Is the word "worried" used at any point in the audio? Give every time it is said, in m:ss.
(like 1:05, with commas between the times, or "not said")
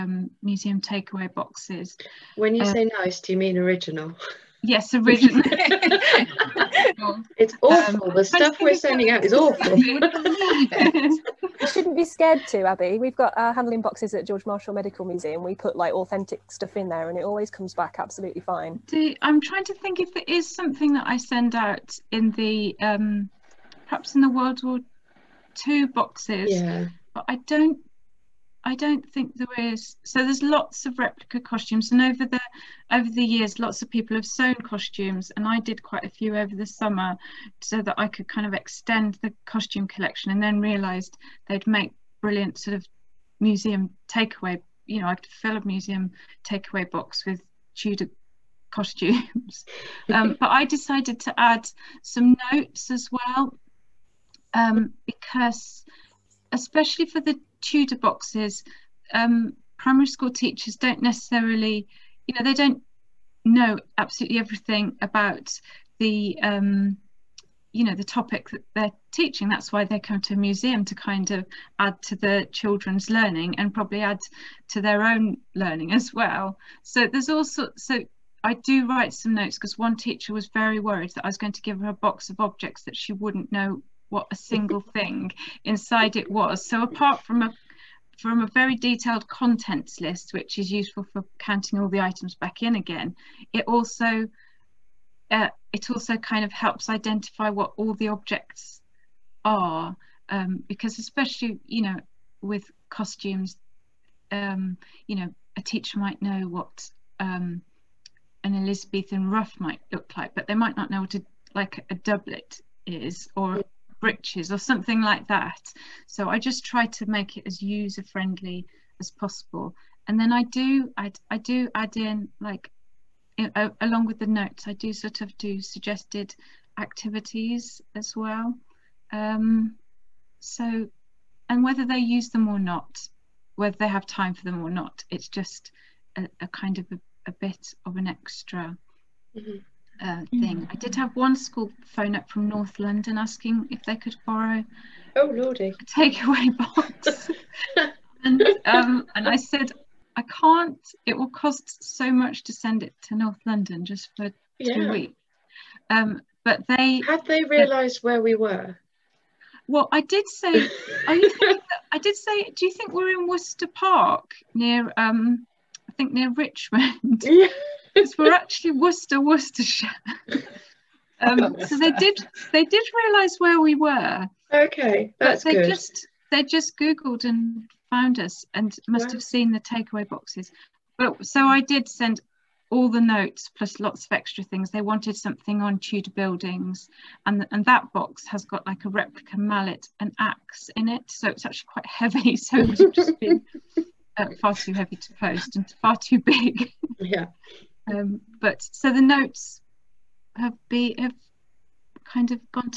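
1:20.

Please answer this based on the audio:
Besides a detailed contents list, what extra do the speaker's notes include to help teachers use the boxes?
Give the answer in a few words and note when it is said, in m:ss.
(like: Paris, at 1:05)
Suggested activities, at 2:05.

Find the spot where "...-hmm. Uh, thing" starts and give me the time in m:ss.
2:19.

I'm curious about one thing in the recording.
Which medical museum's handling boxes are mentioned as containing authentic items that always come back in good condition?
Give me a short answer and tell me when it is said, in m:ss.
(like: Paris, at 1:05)
George Marshall Medical Museum, at 0:14.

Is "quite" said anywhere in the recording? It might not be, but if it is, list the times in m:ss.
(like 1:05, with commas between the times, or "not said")
0:35, 3:11.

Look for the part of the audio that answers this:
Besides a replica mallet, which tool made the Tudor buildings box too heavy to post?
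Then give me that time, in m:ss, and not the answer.
3:10.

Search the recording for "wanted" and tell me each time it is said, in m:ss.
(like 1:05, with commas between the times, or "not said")
3:04.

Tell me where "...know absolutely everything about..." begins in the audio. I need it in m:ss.
1:03.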